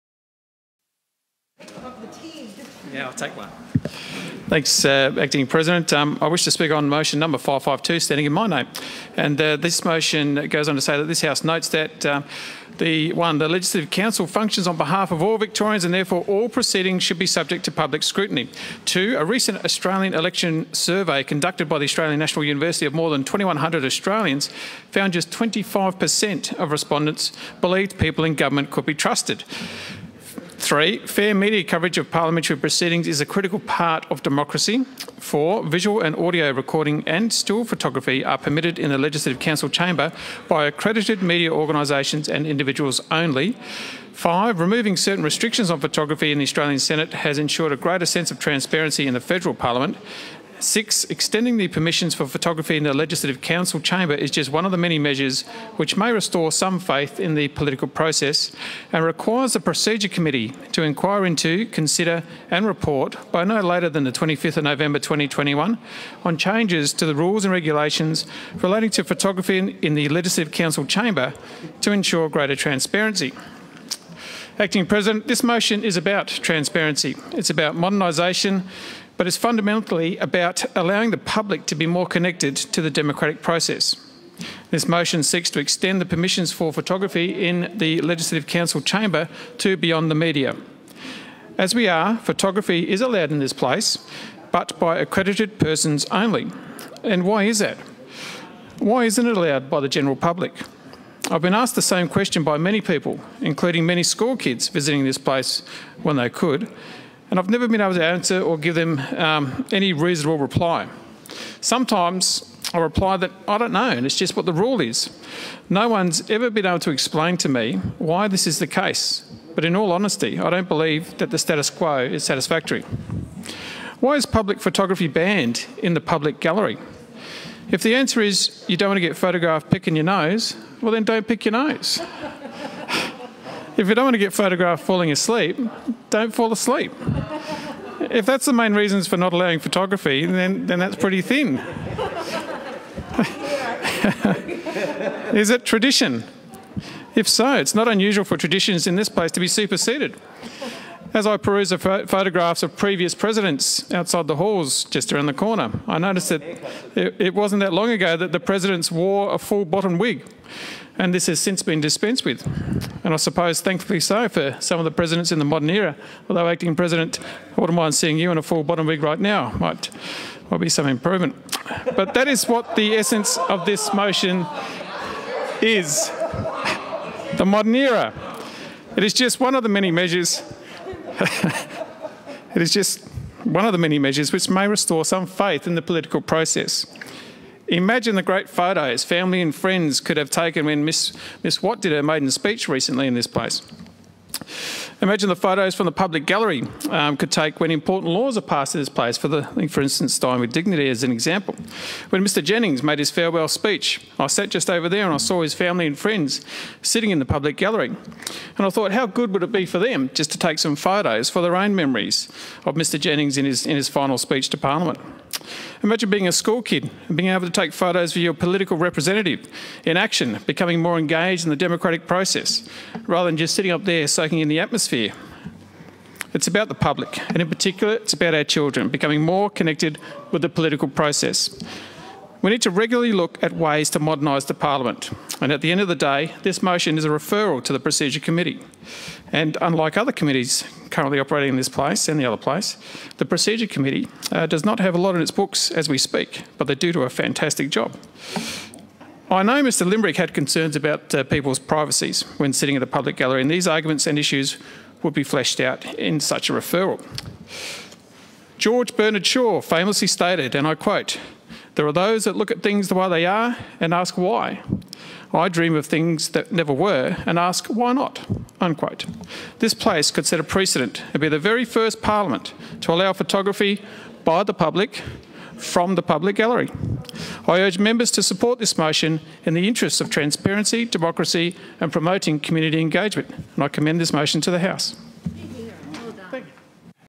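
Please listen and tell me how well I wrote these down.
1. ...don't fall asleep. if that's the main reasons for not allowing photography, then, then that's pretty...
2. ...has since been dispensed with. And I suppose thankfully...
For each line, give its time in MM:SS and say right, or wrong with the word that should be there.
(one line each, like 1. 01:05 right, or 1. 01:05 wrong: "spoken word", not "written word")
1. 02:16 right
2. 02:41 right.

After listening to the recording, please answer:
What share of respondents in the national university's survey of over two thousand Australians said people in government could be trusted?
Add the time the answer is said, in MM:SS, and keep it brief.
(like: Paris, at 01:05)
25%, at 00:25.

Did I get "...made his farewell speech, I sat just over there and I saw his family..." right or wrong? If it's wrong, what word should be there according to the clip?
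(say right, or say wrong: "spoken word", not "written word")
right.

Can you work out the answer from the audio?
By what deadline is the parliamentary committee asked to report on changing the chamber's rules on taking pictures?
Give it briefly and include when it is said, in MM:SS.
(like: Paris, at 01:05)
25 November 2021, at 01:04.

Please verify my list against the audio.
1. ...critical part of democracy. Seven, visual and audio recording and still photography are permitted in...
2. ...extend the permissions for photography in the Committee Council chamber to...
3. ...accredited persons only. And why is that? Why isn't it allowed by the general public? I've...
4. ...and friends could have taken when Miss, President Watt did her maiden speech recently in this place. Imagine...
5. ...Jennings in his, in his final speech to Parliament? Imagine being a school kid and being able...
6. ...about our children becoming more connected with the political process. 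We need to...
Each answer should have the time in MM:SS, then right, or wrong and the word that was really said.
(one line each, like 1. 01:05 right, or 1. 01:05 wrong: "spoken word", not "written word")
1. 00:33 wrong: "Four", not "Seven"
2. 01:25 wrong: "Legislative", not "Committee"
3. 01:34 right
4. 03:09 wrong: "Miss", not "President"
5. 03:32 right
6. 03:48 right.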